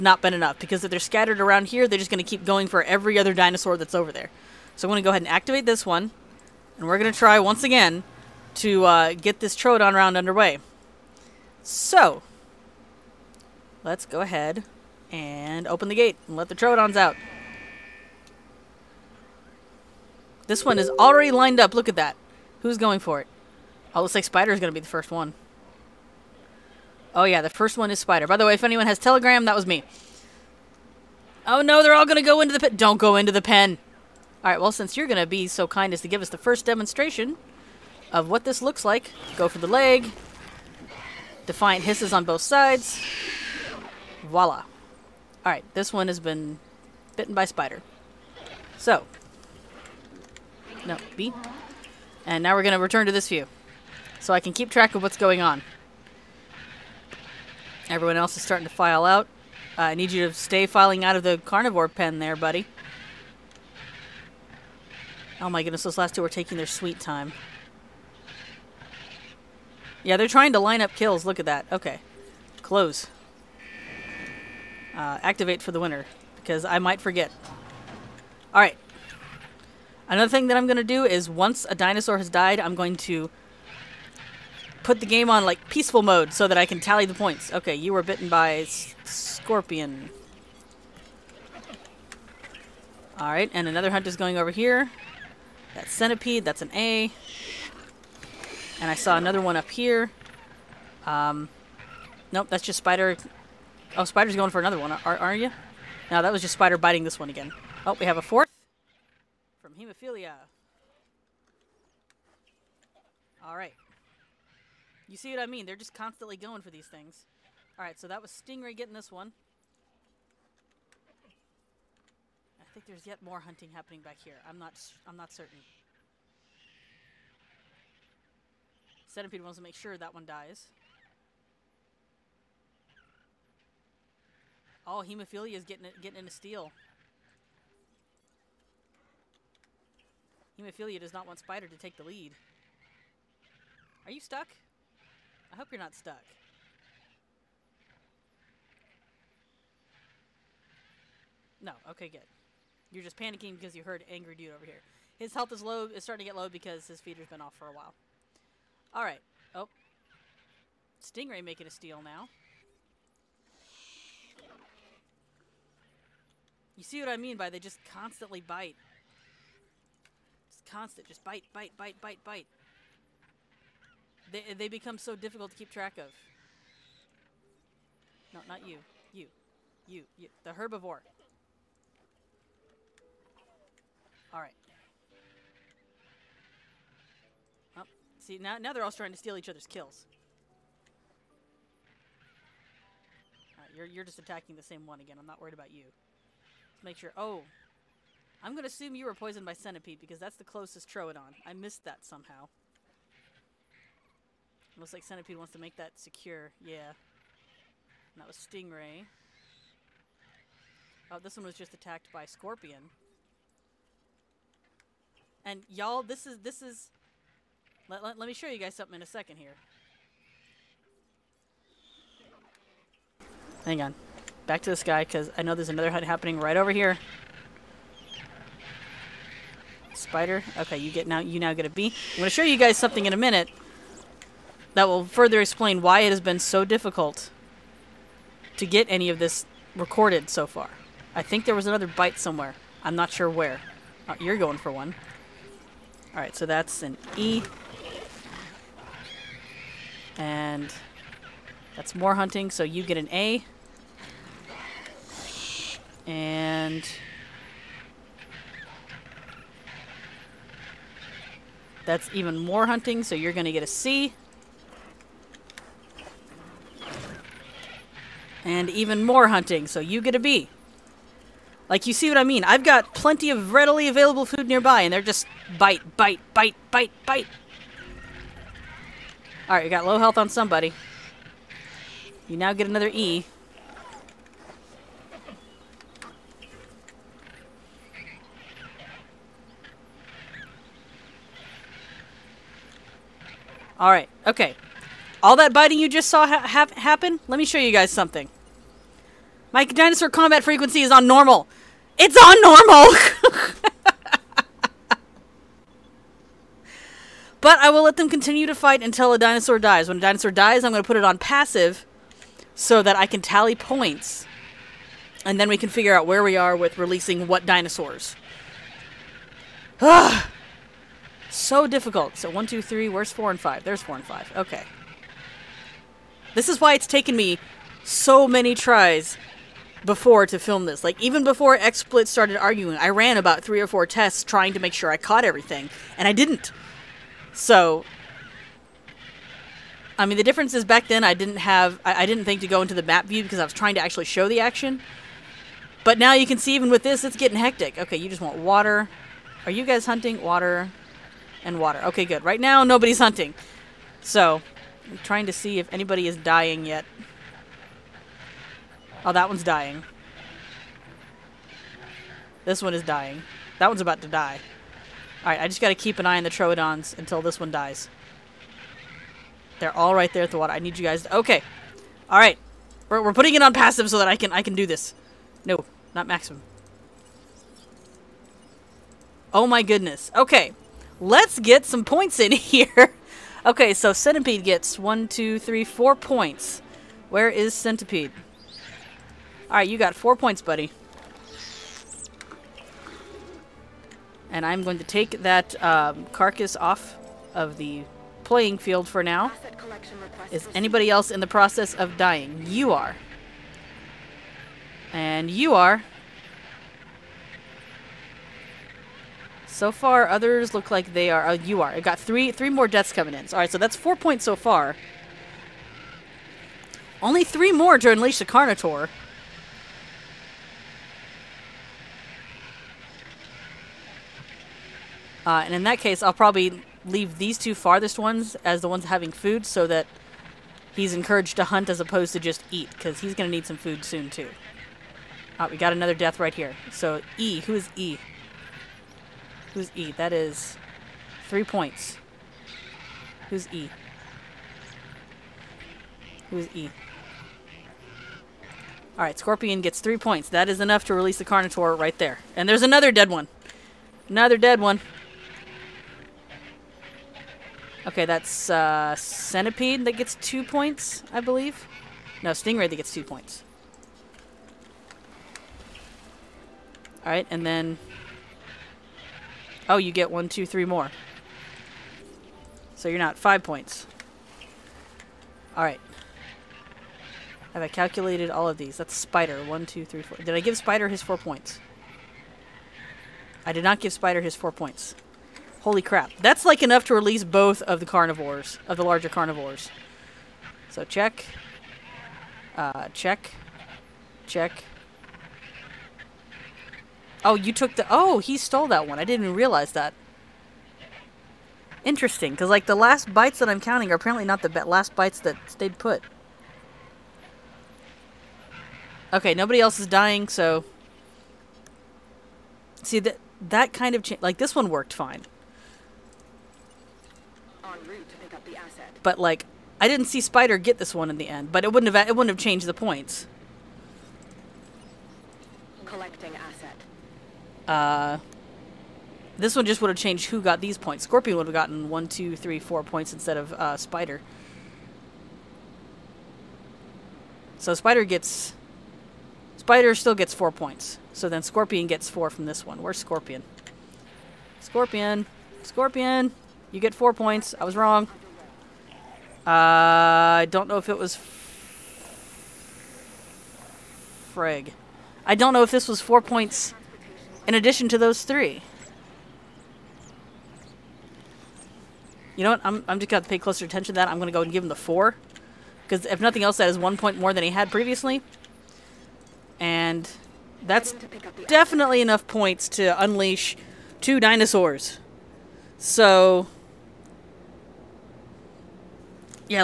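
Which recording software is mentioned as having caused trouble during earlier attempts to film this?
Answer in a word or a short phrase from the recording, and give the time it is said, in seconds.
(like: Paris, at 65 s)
XSplit, at 331 s.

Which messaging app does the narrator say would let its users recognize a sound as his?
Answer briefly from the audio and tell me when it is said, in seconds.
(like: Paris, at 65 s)
Telegram, at 28 s.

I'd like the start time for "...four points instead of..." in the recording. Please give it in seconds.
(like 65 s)
532 s.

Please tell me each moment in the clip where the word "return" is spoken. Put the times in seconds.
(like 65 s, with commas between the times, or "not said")
52 s.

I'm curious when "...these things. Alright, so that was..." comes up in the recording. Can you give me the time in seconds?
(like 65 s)
116 s.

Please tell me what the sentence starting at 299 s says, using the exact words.
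My dinosaur combat frequency is on normal.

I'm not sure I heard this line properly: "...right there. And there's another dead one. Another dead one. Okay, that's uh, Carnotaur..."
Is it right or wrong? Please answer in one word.
wrong.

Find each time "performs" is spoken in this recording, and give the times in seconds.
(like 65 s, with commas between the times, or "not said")
not said.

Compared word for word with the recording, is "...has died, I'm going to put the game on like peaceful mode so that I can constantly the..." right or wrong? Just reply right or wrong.
wrong.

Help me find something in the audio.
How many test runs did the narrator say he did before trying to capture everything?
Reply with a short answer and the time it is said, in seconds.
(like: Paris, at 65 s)
3 or 4, at 333 s.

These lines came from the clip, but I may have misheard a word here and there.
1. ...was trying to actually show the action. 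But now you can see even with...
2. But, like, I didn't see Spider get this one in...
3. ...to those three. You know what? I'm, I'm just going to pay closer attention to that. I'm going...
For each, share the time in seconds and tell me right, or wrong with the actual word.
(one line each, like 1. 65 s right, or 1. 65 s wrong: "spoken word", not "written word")
1. 343 s right
2. 519 s right
3. 557 s right.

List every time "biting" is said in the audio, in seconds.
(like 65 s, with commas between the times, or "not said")
106 s, 295 s.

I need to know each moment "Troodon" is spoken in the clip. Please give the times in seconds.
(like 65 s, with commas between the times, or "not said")
9 s, 16 s, 200 s, 366 s.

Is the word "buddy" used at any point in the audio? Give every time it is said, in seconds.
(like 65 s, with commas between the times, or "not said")
62 s, 390 s.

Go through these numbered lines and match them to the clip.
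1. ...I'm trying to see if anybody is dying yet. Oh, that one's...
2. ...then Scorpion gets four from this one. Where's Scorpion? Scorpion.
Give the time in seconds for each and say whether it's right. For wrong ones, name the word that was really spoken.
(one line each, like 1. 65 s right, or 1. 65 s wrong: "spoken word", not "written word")
1. 354 s right
2. 541 s right.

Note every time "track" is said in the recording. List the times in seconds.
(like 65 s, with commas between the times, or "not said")
54 s, 175 s.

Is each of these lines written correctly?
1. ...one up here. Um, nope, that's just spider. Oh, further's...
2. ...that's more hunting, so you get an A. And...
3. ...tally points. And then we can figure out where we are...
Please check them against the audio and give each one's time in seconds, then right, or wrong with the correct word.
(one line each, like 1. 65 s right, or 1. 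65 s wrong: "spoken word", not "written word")
1. 99 s wrong: "spider", not "further"
2. 251 s right
3. 313 s right.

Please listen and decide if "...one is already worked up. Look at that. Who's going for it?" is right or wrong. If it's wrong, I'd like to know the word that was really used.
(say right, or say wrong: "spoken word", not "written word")
wrong: "lined", not "worked".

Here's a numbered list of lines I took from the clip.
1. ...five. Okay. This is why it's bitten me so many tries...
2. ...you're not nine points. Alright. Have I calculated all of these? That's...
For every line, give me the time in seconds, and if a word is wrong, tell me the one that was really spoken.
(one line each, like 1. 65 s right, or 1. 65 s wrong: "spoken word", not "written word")
1. 324 s wrong: "taken", not "bitten"
2. 472 s wrong: "five", not "nine".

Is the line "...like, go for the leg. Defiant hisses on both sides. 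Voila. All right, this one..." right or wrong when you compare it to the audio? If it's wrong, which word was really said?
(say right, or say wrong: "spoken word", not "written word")
right.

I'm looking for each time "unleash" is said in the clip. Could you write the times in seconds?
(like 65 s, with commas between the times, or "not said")
417 s, 573 s.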